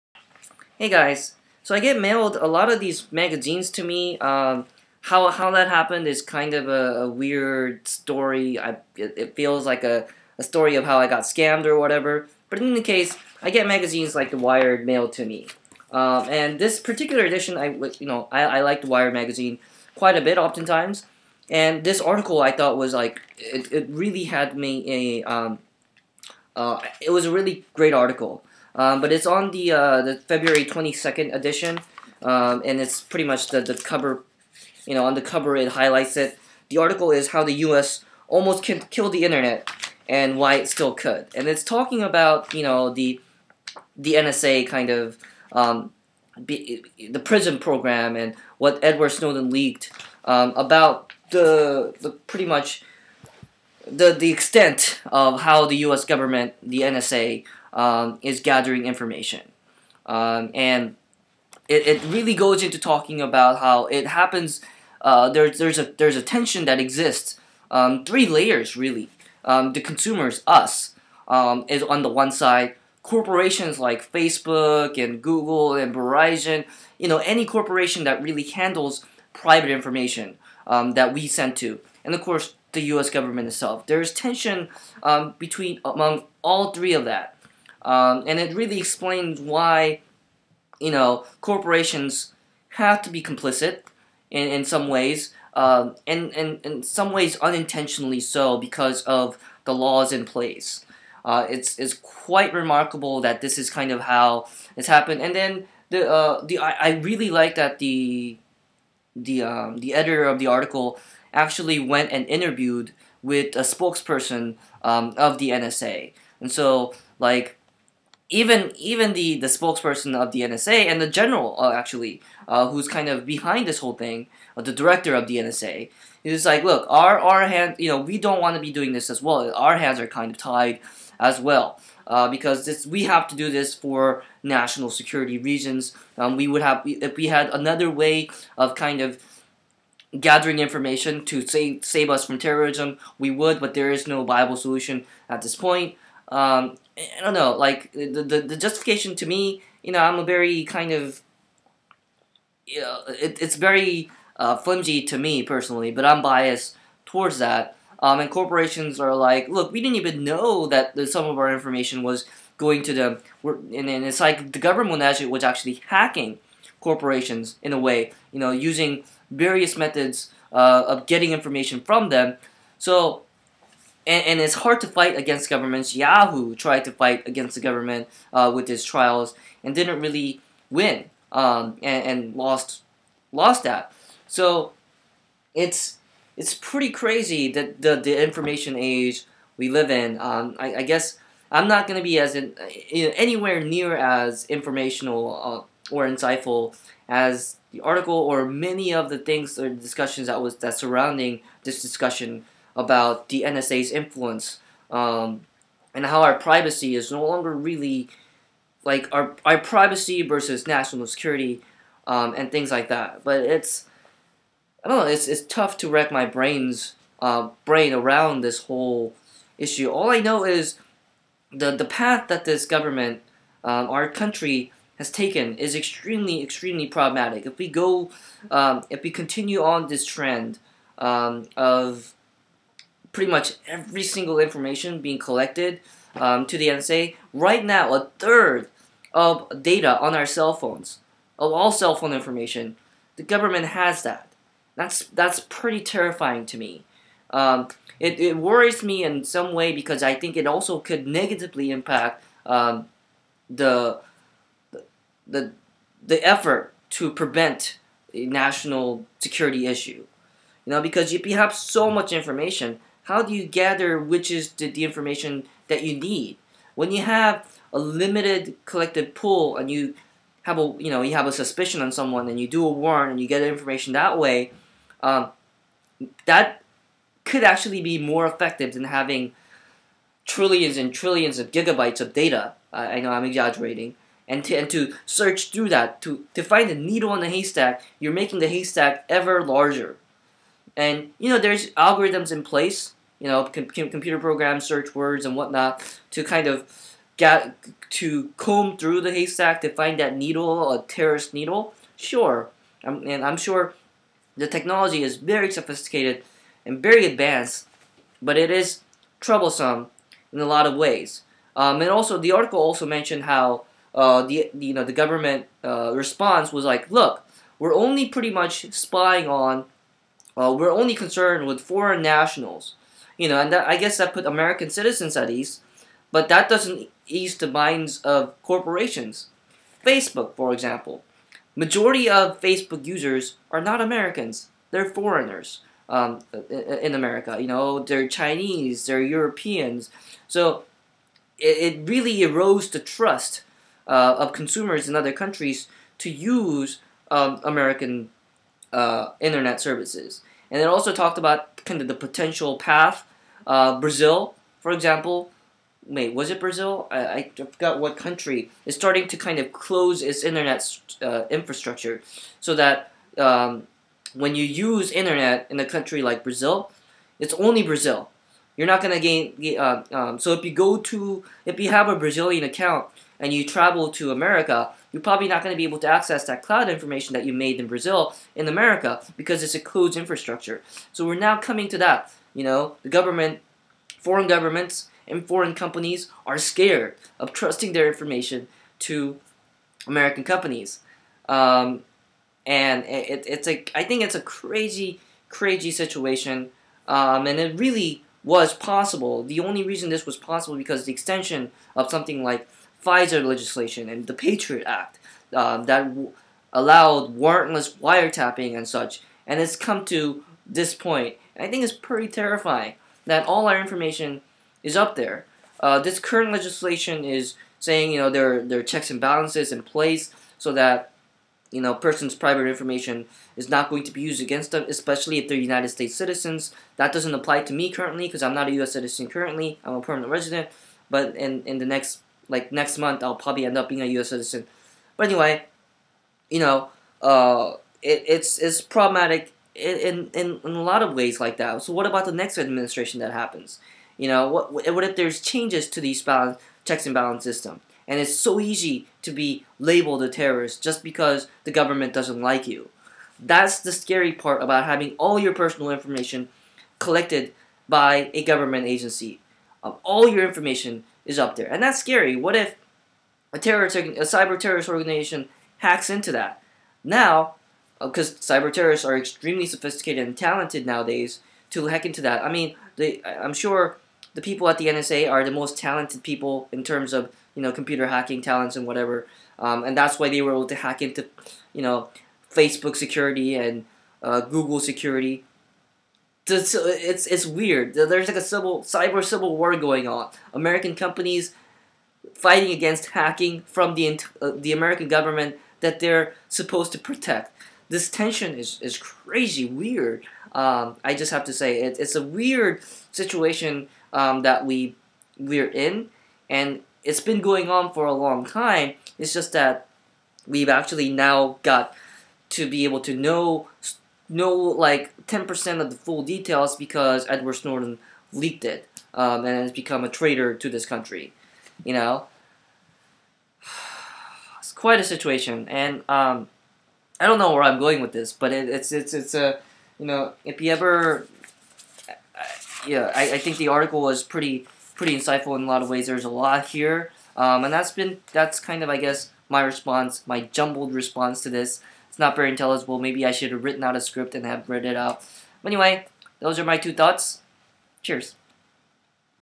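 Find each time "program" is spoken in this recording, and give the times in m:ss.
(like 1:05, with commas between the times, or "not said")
0:47, 4:54.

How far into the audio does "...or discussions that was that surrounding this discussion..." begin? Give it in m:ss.
3:19.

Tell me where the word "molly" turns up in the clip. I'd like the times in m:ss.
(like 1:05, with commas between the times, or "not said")
not said.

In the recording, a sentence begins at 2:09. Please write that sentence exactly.
Our hands are kind of tied as well.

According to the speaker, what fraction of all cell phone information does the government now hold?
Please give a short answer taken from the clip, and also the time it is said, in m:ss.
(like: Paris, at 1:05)
a third, at 3:57.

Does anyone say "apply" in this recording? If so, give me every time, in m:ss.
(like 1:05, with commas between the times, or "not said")
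7:07.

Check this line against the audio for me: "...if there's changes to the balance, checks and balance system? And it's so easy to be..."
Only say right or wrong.
right.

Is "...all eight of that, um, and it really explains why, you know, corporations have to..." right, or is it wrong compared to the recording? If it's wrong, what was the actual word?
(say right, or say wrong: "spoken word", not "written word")
wrong: "three", not "eight".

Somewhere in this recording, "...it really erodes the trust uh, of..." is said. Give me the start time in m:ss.
5:41.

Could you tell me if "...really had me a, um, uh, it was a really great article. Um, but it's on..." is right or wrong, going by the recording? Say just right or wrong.
right.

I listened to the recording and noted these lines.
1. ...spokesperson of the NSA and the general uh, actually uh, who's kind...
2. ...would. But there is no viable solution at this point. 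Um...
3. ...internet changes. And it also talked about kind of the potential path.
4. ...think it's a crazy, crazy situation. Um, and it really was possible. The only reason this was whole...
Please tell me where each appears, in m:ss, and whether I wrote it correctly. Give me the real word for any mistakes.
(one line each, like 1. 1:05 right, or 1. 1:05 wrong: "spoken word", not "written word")
1. 1:59 right
2. 2:23 right
3. 5:49 wrong: "services", not "changes"
4. 6:33 wrong: "possible", not "whole".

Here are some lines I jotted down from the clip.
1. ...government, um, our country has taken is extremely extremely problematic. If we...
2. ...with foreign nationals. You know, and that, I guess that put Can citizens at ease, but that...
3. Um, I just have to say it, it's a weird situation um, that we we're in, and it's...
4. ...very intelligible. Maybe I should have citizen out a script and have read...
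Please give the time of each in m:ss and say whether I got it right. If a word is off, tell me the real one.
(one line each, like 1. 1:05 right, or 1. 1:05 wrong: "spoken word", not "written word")
1. 3:42 right
2. 5:21 wrong: "American", not "Can"
3. 8:20 right
4. 9:02 wrong: "written", not "citizen".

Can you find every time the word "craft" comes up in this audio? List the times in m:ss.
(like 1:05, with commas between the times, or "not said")
not said.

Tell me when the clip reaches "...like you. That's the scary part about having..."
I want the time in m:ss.
7:32.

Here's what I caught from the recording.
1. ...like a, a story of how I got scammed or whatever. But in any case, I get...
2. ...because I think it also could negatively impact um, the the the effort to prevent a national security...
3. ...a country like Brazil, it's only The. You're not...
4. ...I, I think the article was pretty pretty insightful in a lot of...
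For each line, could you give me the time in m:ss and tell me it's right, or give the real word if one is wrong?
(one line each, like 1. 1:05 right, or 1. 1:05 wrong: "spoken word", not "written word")
1. 0:09 right
2. 4:09 right
3. 6:05 wrong: "Brazil", not "The"
4. 8:52 right.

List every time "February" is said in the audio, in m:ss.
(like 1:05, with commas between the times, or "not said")
0:30.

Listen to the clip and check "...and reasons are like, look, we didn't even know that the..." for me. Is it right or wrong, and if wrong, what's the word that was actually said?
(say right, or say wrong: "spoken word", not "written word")
wrong: "corporations", not "reasons".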